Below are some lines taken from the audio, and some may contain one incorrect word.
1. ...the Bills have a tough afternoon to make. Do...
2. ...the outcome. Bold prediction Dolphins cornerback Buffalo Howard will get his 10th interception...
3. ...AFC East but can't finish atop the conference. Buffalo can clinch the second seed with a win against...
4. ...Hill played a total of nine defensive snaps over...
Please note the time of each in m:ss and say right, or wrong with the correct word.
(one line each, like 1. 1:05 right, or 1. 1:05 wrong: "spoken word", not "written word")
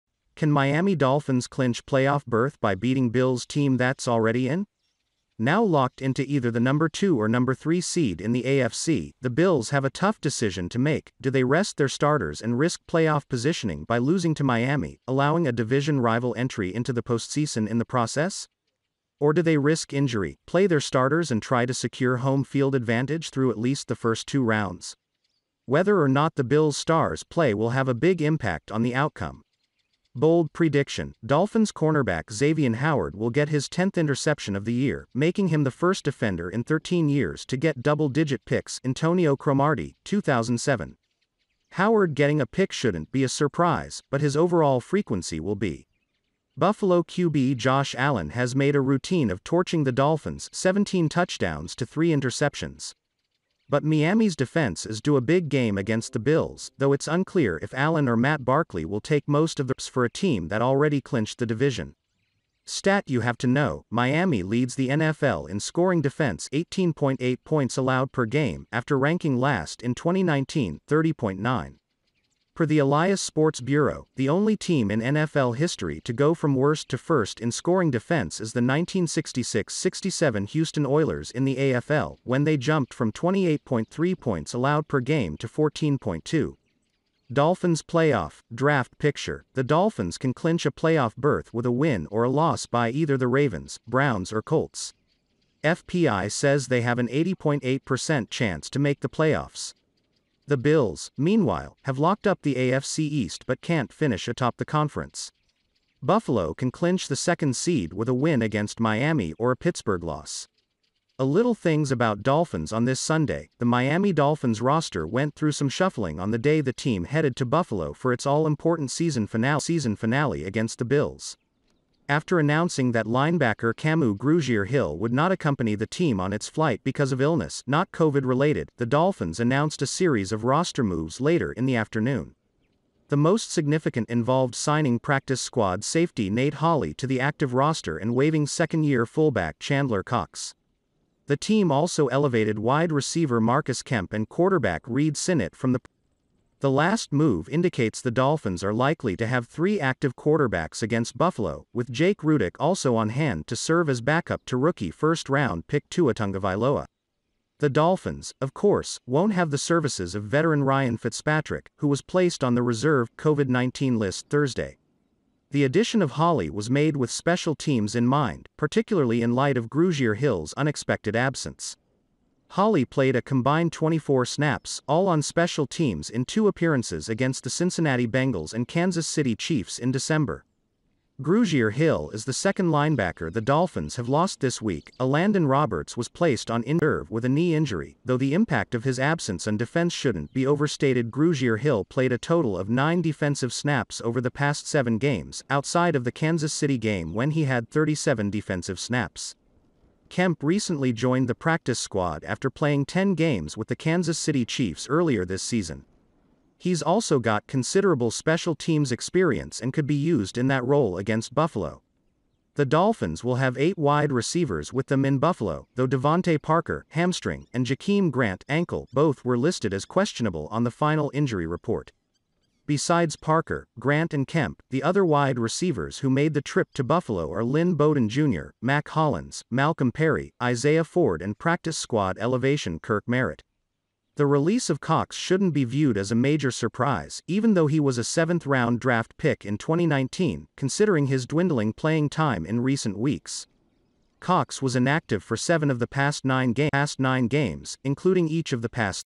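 1. 0:09 wrong: "decision", not "afternoon"
2. 0:28 wrong: "Xavier", not "Buffalo"
3. 1:42 right
4. 3:11 right.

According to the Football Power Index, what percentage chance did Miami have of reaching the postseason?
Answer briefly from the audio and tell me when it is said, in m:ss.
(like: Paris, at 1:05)
80.8%, at 1:37.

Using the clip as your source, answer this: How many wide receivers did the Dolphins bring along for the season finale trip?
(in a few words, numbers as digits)
8.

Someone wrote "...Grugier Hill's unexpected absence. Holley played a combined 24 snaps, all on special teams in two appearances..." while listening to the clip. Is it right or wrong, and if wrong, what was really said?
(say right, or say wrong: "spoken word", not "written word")
right.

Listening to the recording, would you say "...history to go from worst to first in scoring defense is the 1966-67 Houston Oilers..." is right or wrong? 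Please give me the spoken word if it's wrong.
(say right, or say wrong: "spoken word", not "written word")
right.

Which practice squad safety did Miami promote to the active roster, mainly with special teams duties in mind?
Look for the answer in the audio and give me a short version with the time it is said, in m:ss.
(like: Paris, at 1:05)
Nate Holley, at 2:16.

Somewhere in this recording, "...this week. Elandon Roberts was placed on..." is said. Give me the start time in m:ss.
3:04.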